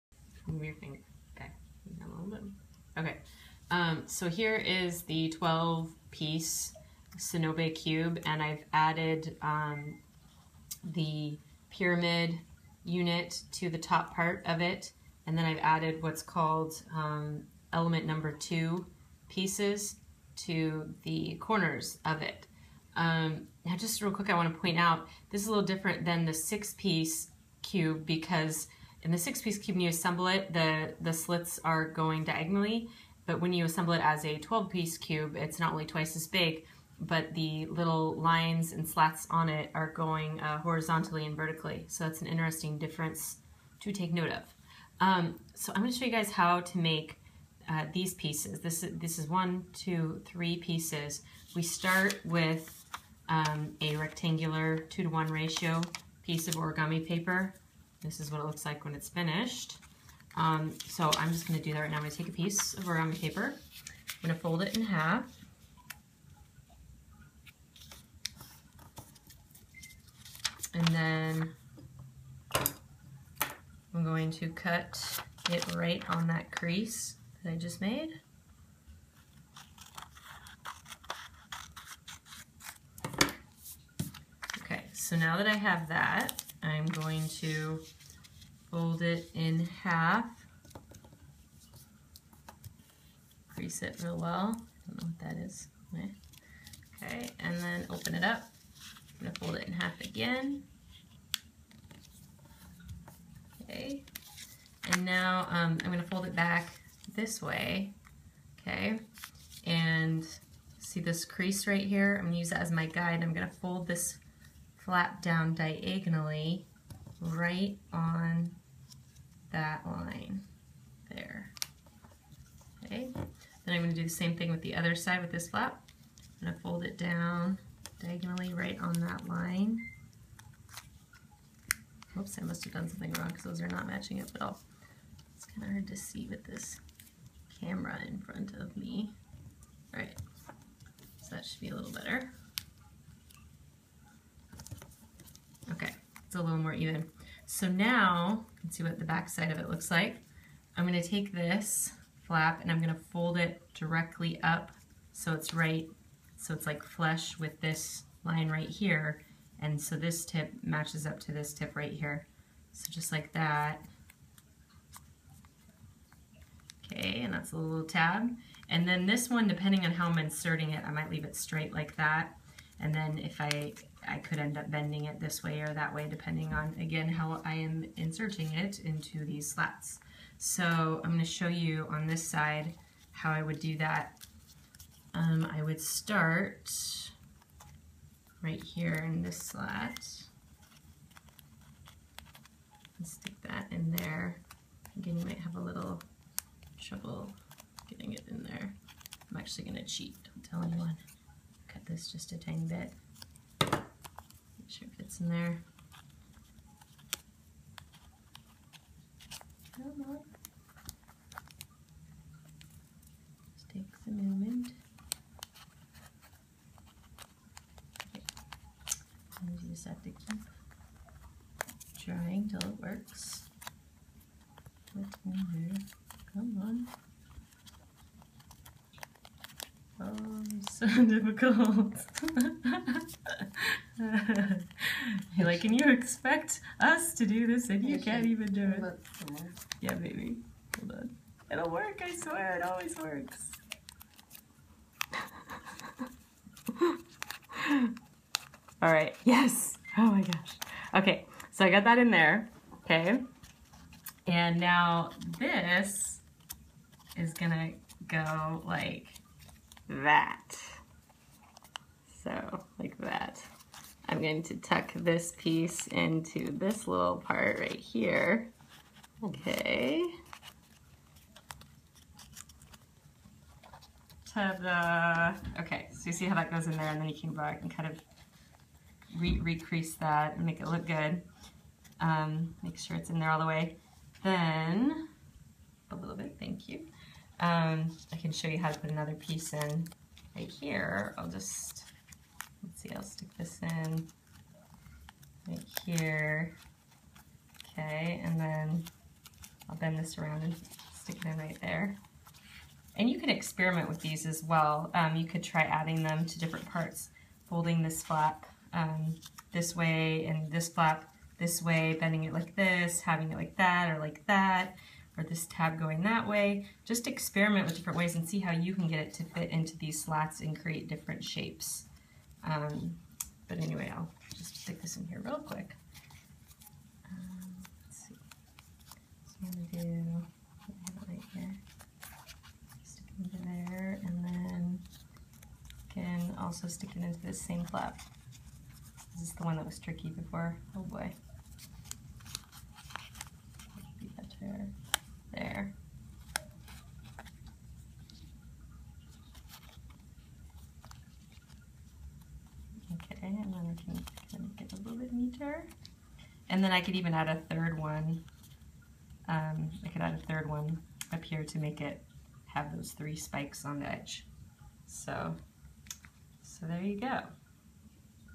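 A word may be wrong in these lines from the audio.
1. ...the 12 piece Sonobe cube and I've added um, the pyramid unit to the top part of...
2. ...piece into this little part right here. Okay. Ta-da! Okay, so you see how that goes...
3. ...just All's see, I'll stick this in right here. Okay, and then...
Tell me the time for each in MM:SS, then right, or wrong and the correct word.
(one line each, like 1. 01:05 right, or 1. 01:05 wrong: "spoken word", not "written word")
1. 00:05 right
2. 04:25 right
3. 04:51 wrong: "Let", not "All".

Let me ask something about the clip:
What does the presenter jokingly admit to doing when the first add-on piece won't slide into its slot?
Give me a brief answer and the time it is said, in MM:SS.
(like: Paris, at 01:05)
cheat, at 03:19.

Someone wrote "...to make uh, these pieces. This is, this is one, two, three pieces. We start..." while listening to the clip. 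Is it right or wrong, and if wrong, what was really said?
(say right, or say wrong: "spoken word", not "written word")
right.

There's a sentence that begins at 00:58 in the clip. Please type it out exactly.
This is what it looks like when it's finished.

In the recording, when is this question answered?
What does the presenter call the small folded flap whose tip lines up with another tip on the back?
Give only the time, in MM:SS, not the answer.
02:47.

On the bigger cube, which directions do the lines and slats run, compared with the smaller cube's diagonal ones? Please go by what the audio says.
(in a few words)
horizontally and vertically.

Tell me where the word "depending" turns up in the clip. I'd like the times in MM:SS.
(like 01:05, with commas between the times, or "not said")
02:49, 02:56.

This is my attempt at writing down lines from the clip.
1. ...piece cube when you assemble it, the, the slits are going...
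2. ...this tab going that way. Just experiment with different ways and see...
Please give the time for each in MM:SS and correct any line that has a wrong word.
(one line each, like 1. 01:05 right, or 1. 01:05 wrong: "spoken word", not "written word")
1. 00:29 right
2. 05:15 right.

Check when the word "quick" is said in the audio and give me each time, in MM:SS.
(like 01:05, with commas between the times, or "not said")
00:24, 05:25.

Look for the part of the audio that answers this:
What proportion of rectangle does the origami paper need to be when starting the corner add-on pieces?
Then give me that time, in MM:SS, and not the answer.
00:54.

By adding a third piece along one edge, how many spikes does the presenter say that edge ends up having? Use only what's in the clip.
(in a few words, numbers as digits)
3.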